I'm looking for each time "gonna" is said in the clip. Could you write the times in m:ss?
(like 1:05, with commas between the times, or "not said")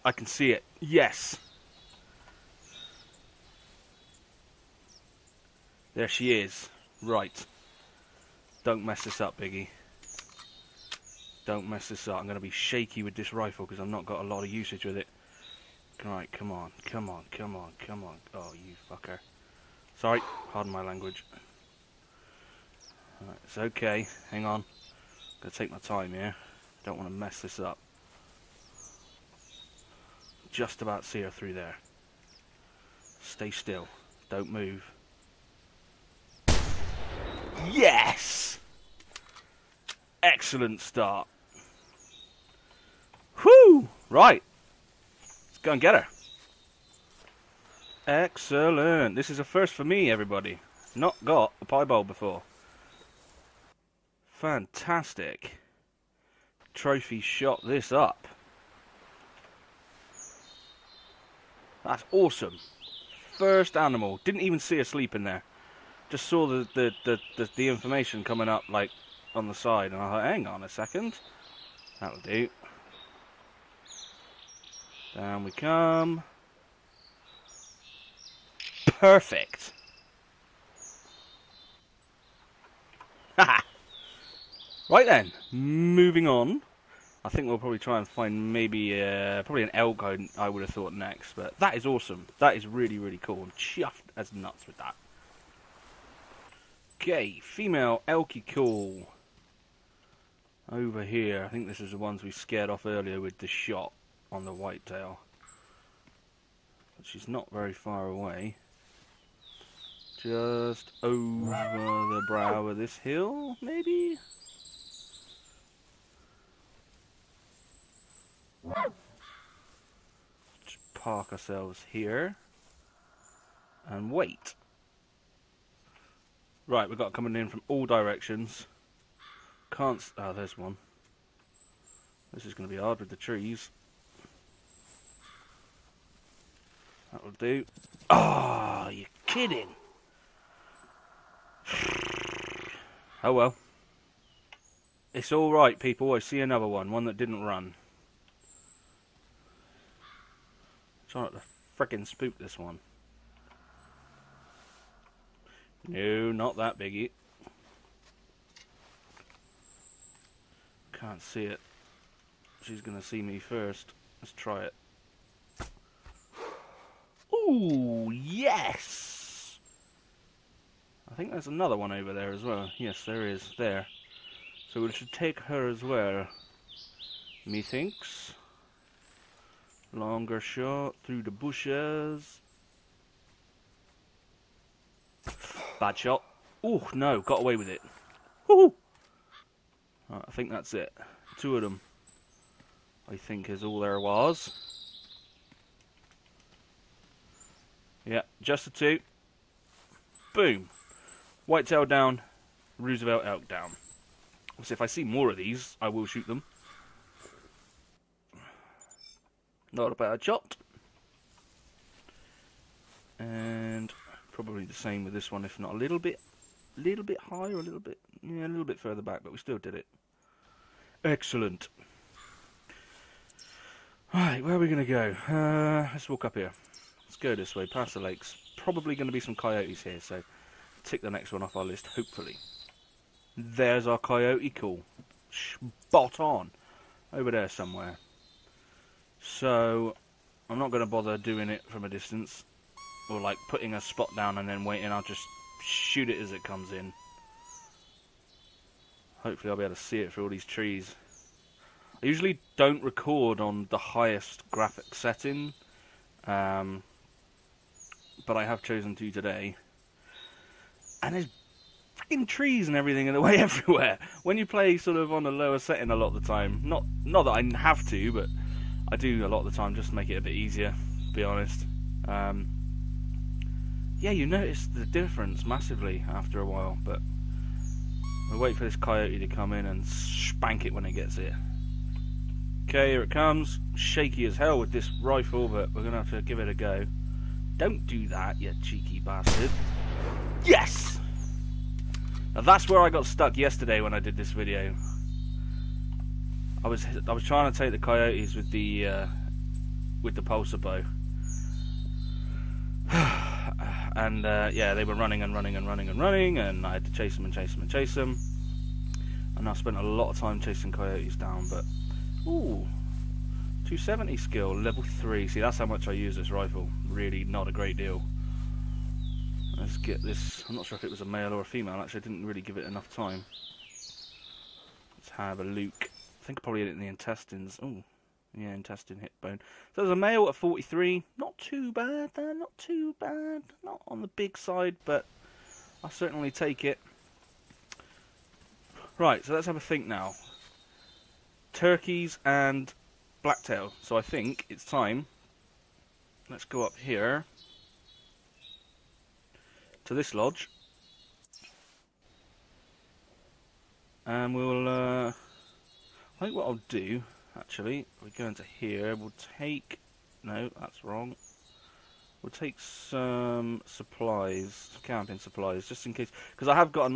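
0:25, 2:42.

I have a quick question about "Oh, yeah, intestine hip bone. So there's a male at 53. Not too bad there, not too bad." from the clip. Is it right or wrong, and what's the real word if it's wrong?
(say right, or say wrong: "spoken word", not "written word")
wrong: "43", not "53".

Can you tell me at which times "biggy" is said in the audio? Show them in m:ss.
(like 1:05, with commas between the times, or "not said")
0:09, 2:36.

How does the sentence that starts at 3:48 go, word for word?
Probably going to be some coyotes here, so tick the next one off our list, hopefully.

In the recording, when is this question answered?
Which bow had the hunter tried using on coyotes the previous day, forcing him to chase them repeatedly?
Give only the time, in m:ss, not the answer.
5:00.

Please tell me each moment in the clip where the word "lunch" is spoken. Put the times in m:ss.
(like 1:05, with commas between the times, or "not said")
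not said.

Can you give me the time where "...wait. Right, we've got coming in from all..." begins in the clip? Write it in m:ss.
2:04.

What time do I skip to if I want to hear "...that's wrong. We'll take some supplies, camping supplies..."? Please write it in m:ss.
6:00.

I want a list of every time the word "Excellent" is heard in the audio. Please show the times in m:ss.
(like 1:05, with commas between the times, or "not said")
0:40, 0:48, 3:41.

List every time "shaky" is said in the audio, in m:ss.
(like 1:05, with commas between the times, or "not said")
0:12, 4:43.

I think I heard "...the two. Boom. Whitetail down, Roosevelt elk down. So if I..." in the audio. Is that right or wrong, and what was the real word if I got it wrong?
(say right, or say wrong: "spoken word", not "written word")
right.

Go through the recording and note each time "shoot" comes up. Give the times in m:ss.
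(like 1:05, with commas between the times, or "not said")
3:26, 4:05.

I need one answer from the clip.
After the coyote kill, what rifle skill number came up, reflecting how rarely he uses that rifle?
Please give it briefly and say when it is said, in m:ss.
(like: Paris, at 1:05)
270, at 5:13.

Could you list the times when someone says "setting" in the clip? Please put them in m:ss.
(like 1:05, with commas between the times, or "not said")
4:14, 4:25.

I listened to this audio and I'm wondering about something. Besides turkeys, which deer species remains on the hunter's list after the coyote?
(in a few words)
Blacktail.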